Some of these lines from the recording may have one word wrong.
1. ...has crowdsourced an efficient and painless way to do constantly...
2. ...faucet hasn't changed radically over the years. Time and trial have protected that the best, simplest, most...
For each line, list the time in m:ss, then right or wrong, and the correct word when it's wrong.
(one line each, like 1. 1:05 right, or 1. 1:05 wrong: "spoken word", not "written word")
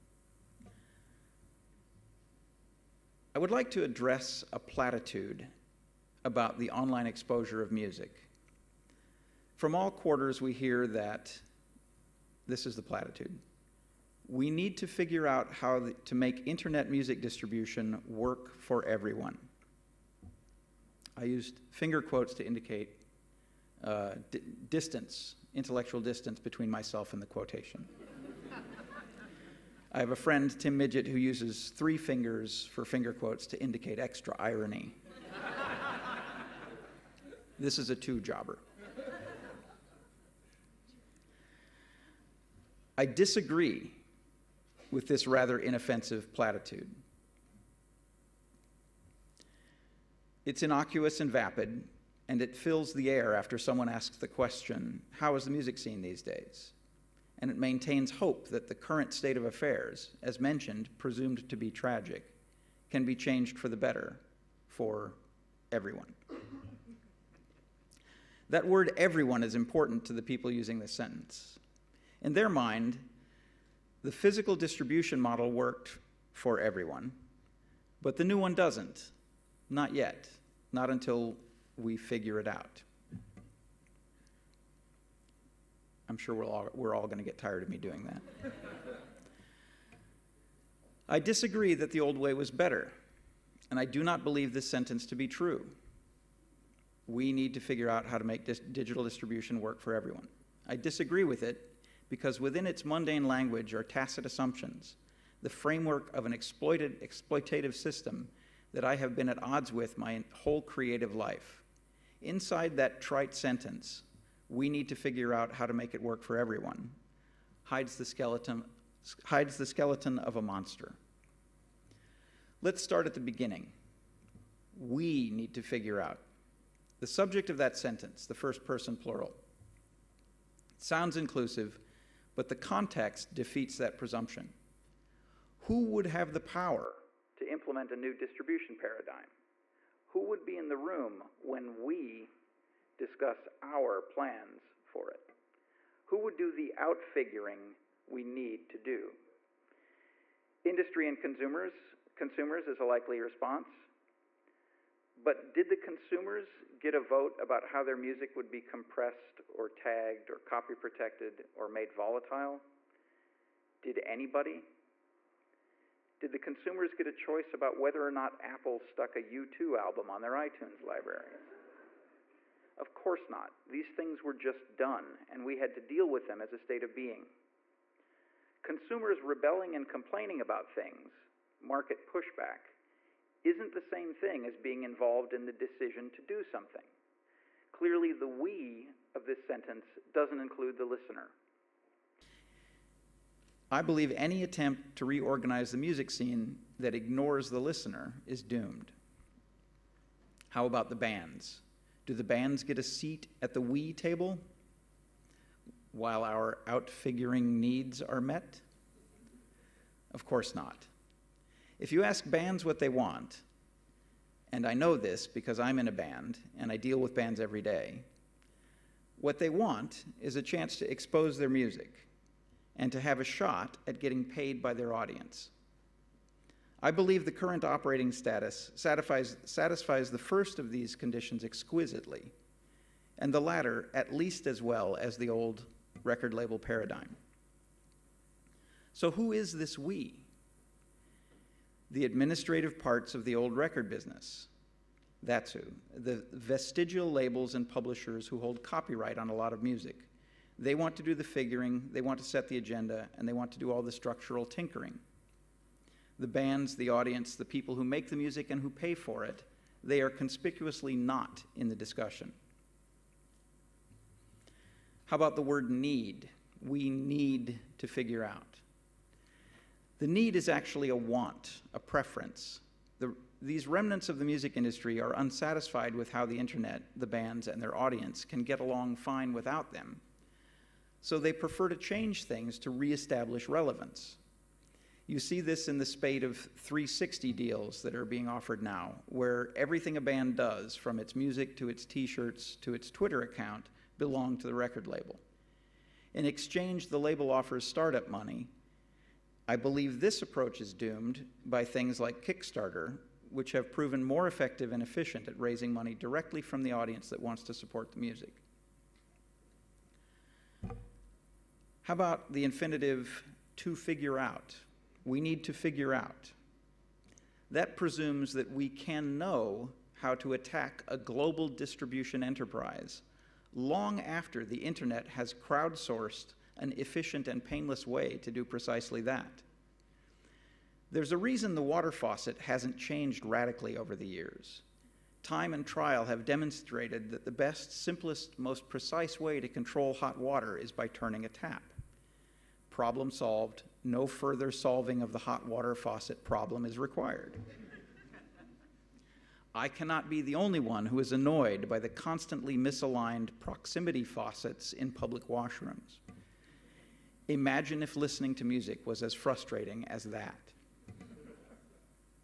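1. 5:25 wrong: "precisely", not "constantly"
2. 5:31 wrong: "demonstrated", not "protected".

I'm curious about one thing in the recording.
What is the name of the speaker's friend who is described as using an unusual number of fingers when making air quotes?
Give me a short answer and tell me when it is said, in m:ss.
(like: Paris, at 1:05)
Tim Midyett, at 0:30.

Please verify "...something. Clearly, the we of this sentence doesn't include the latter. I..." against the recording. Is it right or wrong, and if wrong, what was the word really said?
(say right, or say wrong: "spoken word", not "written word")
wrong: "listener", not "latter".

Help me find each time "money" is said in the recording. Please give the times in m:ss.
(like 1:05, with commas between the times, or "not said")
4:58, 5:05.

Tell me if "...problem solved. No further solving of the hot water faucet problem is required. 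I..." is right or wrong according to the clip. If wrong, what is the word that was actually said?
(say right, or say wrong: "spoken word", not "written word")
right.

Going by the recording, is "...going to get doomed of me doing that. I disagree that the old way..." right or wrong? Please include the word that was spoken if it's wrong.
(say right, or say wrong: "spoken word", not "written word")
wrong: "tired", not "doomed".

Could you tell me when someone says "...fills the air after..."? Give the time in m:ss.
0:52.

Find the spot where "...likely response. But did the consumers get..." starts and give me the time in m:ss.
2:32.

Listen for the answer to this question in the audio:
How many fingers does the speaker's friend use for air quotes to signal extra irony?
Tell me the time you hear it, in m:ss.
0:31.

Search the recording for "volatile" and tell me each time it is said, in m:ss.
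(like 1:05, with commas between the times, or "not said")
2:41.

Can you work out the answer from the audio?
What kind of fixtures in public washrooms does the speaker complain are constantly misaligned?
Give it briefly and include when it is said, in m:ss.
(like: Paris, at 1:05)
proximity faucets, at 5:53.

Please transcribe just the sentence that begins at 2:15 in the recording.
Who would have the power to implement a new distribution paradigm?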